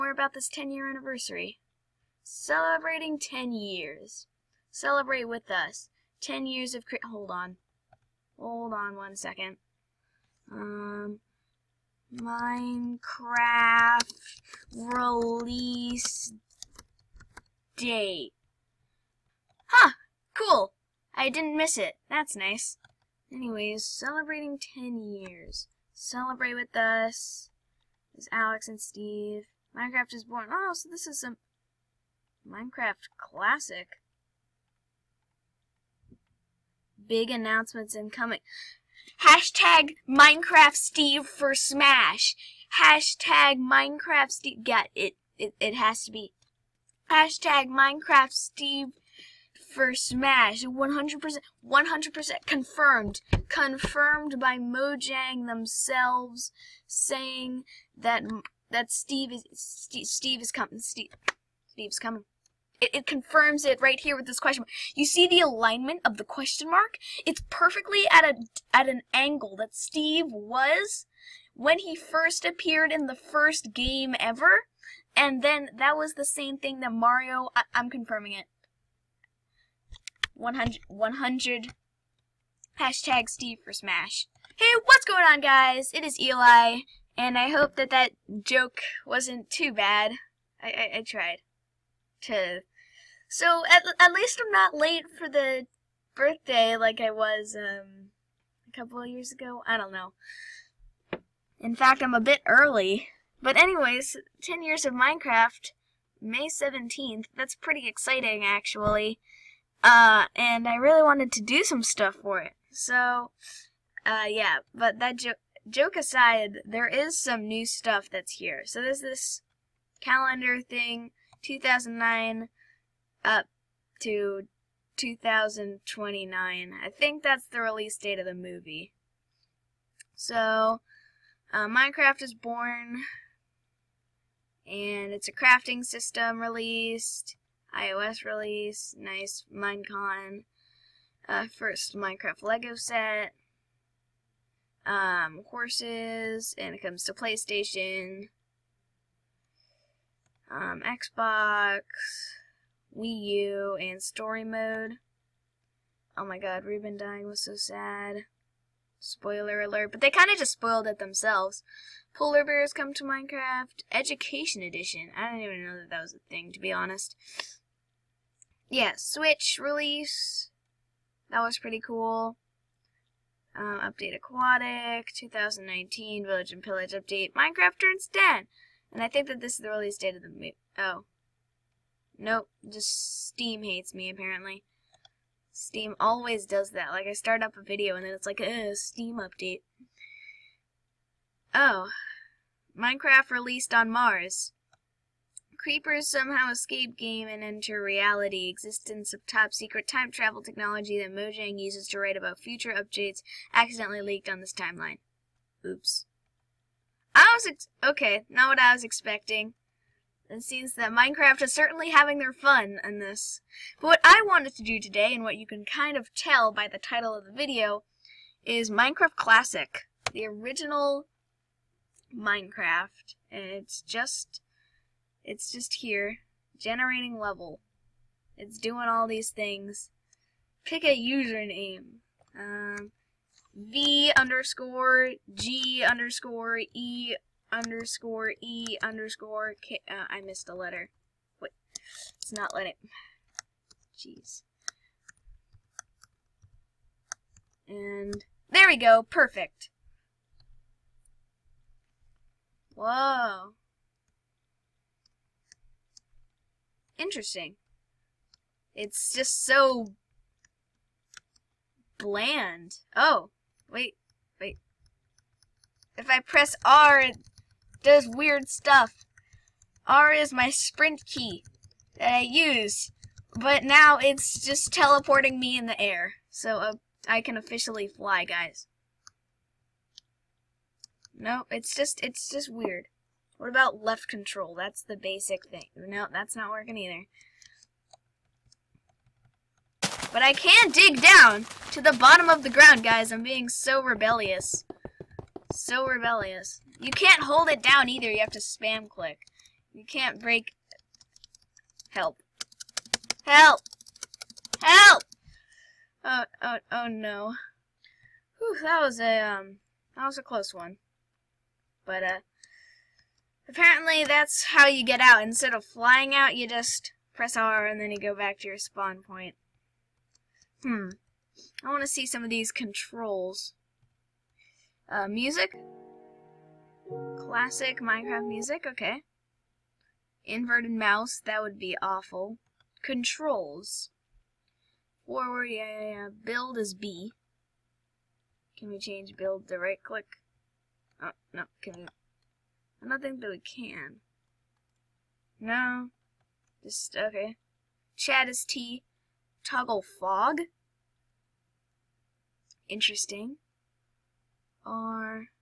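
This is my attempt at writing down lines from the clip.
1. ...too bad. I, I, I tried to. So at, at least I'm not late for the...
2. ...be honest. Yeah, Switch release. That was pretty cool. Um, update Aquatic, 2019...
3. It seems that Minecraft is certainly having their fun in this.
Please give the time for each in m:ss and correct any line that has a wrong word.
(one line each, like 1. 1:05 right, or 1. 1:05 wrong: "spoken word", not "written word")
1. 1:29 right
2. 2:46 right
3. 3:30 right.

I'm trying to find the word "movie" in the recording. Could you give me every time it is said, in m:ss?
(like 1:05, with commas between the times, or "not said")
2:08, 3:00.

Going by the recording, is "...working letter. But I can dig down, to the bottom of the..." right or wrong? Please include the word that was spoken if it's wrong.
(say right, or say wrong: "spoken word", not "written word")
wrong: "either", not "letter".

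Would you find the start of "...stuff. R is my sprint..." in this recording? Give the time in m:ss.
4:28.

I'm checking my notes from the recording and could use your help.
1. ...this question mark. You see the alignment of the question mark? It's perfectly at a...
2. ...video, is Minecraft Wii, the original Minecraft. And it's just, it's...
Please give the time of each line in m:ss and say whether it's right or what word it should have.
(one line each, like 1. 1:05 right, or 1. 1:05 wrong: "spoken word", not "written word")
1. 1:04 right
2. 3:37 wrong: "Classic", not "Wii".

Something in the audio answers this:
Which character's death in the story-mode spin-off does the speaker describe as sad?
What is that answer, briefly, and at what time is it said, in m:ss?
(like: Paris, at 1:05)
Reuben, at 2:36.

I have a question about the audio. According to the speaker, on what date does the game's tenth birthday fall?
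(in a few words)
May 17th.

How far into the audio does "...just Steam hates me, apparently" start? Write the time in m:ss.
3:02.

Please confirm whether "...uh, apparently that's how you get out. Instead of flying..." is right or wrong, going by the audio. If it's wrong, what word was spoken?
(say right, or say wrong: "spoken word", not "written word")
right.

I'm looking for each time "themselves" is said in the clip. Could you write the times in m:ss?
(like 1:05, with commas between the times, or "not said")
0:55, 2:40.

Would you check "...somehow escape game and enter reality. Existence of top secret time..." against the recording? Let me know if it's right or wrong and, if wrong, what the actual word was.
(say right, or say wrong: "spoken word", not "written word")
right.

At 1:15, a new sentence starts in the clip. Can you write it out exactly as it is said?
And then that was the same thing that Mario, I, am confirming it.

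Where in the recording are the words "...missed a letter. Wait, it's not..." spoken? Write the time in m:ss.
4:00.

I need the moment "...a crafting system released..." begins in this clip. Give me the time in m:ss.
2:15.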